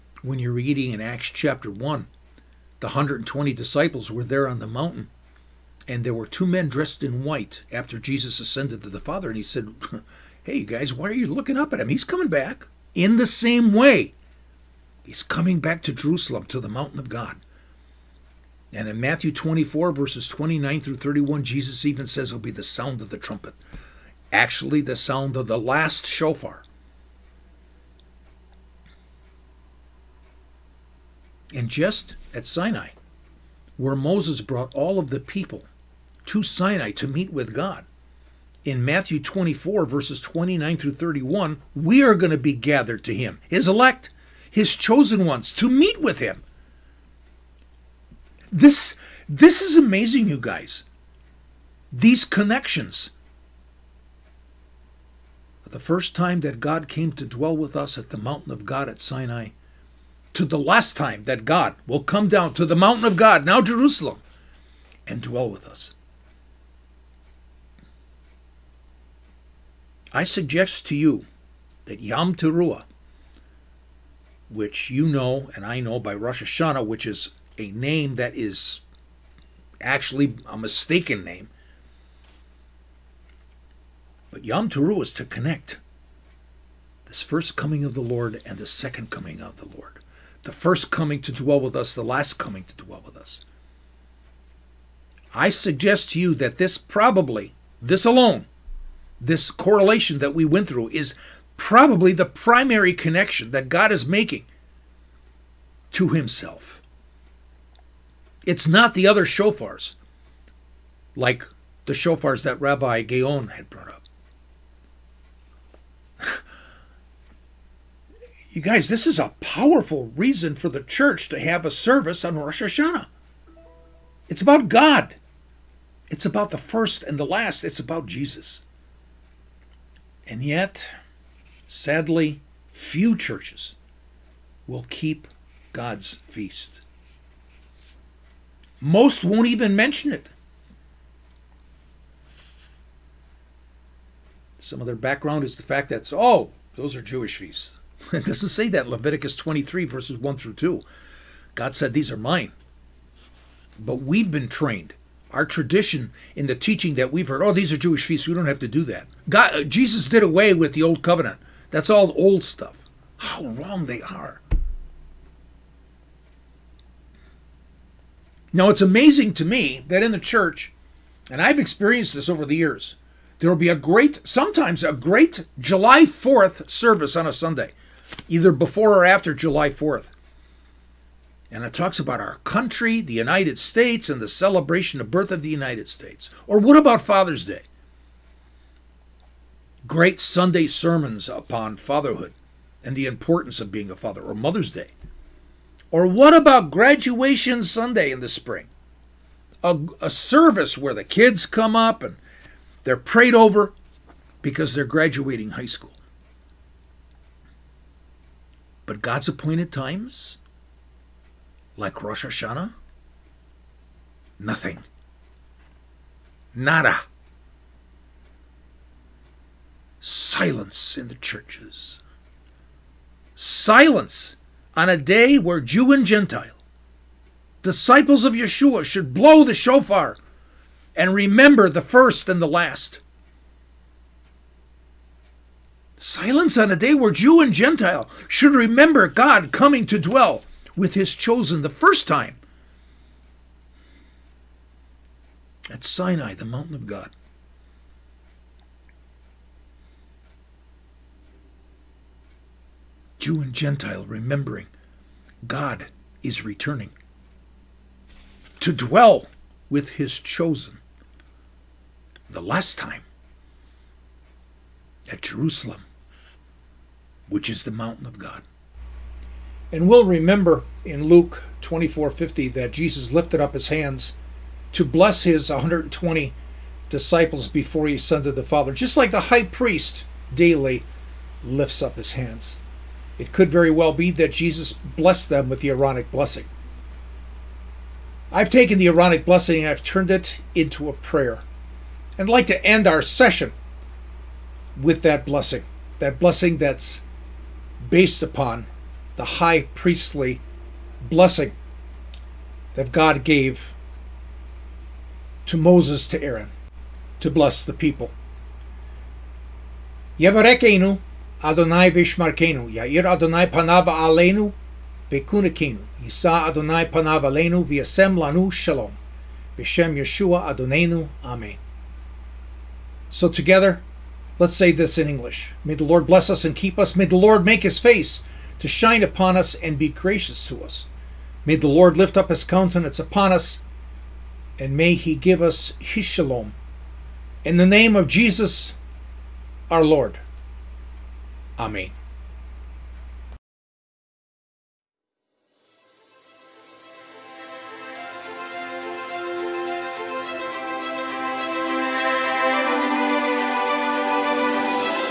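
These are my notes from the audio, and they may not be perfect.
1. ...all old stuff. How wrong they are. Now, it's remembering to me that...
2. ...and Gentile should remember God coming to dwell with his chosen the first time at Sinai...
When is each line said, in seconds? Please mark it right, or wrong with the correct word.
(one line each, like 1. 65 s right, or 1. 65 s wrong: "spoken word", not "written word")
1. 161 s wrong: "amazing", not "remembering"
2. 237 s right.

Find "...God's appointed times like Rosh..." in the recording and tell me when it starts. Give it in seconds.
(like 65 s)
209 s.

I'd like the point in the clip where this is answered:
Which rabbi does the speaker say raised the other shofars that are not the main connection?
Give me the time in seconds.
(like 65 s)
112 s.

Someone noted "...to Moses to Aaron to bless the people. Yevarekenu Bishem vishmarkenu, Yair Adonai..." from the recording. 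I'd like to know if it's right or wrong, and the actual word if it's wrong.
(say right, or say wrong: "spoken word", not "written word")
wrong: "Adonai", not "Bishem".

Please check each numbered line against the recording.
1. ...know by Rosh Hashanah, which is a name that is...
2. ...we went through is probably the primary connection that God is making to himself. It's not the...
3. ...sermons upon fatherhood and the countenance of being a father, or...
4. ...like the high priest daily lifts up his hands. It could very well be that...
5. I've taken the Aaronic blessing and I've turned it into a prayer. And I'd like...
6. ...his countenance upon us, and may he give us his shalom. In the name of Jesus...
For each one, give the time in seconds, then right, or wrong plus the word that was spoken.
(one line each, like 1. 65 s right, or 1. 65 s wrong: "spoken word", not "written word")
1. 75 s right
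2. 100 s right
3. 190 s wrong: "importance", not "countenance"
4. 278 s right
5. 288 s right
6. 332 s right.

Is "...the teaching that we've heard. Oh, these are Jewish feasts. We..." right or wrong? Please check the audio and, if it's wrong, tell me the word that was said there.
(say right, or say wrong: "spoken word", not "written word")
right.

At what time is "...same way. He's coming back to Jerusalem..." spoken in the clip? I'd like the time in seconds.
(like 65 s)
13 s.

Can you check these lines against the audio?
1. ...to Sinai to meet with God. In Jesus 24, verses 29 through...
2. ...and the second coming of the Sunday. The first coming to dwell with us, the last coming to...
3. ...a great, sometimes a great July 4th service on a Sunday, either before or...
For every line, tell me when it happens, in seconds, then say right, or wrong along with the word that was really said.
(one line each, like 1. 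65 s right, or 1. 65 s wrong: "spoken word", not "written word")
1. 36 s wrong: "Matthew", not "Jesus"
2. 88 s wrong: "Lord", not "Sunday"
3. 173 s right.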